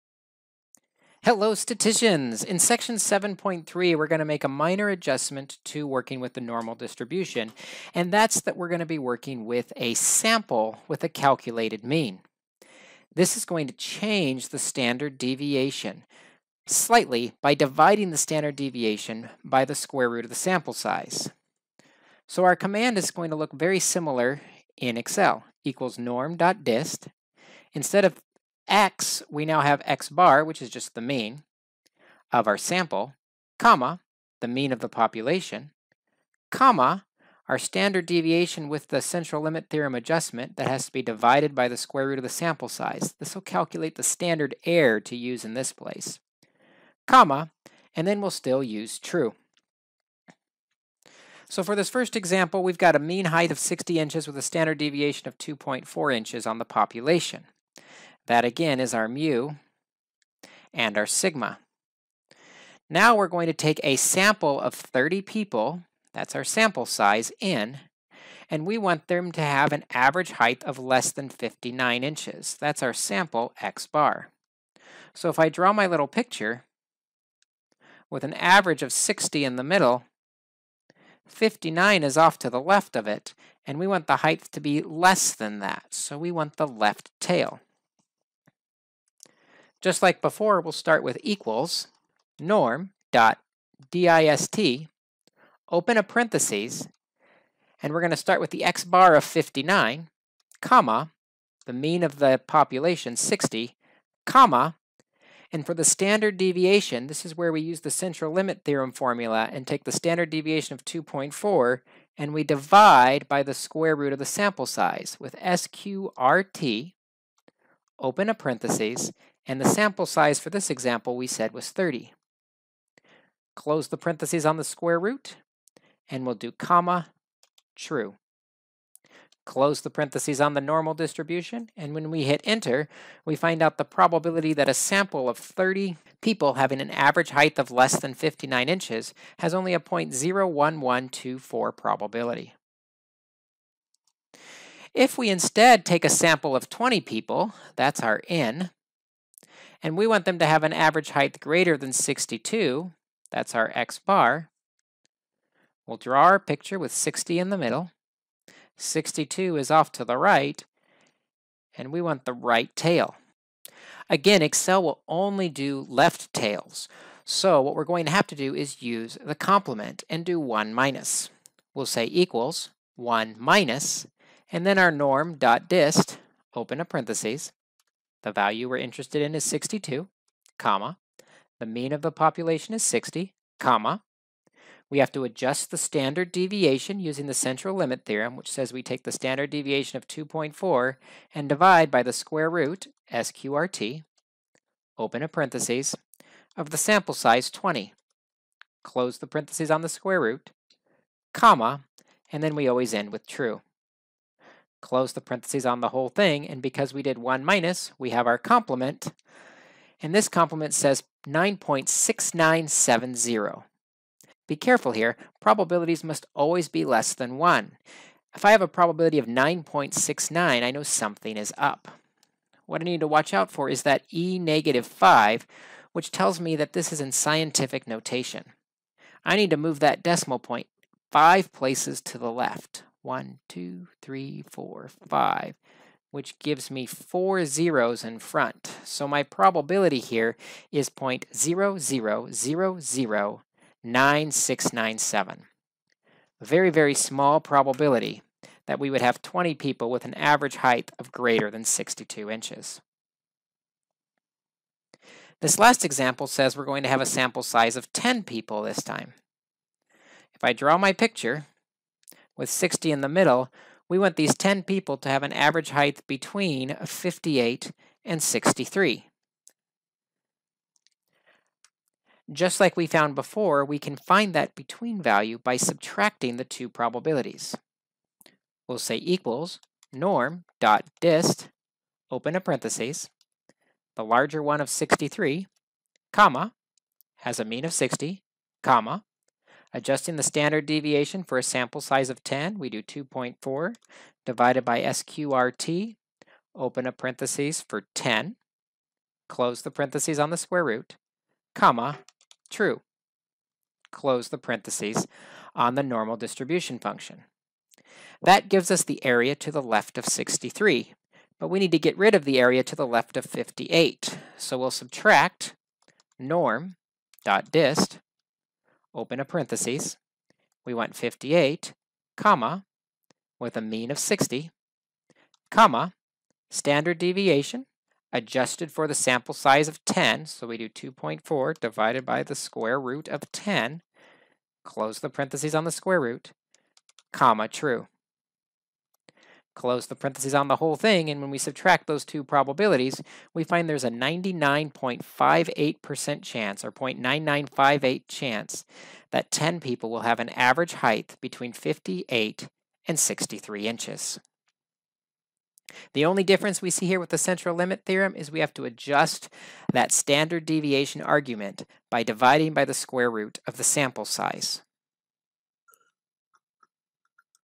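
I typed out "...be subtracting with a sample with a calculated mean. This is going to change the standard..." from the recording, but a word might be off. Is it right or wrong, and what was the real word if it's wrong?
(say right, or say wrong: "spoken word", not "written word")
wrong: "working", not "subtracting".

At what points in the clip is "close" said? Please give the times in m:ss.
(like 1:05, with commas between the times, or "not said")
2:03, 2:09, 3:18, 3:24, 4:59, 5:03, 5:34, 5:39.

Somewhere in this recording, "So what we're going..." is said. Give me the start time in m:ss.
2:47.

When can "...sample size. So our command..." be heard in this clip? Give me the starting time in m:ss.
0:20.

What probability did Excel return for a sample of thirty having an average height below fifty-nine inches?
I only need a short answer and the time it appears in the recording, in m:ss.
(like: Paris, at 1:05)
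0.01124, at 2:19.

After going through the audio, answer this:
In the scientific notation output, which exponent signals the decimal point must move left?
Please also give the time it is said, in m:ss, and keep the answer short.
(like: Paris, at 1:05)
e negative 5, at 3:44.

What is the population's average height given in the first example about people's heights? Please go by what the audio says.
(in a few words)
60 inches.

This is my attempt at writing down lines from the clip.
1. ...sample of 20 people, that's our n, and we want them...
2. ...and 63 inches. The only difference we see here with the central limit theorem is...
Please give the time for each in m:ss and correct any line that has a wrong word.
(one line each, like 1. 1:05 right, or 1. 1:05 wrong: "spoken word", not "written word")
1. 2:26 right
2. 5:52 right.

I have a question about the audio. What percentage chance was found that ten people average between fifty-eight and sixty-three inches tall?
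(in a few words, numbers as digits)
99.58%.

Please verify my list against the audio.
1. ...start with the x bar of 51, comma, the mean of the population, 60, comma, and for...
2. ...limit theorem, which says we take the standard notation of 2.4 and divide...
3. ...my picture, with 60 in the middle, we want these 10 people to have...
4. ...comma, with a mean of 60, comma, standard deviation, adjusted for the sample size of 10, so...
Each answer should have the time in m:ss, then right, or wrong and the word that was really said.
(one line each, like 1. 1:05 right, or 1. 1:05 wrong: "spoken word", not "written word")
1. 1:38 wrong: "59", not "51"
2. 3:07 wrong: "deviation", not "notation"
3. 4:20 right
4. 5:22 right.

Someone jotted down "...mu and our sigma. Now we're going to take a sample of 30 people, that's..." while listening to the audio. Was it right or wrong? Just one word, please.
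right.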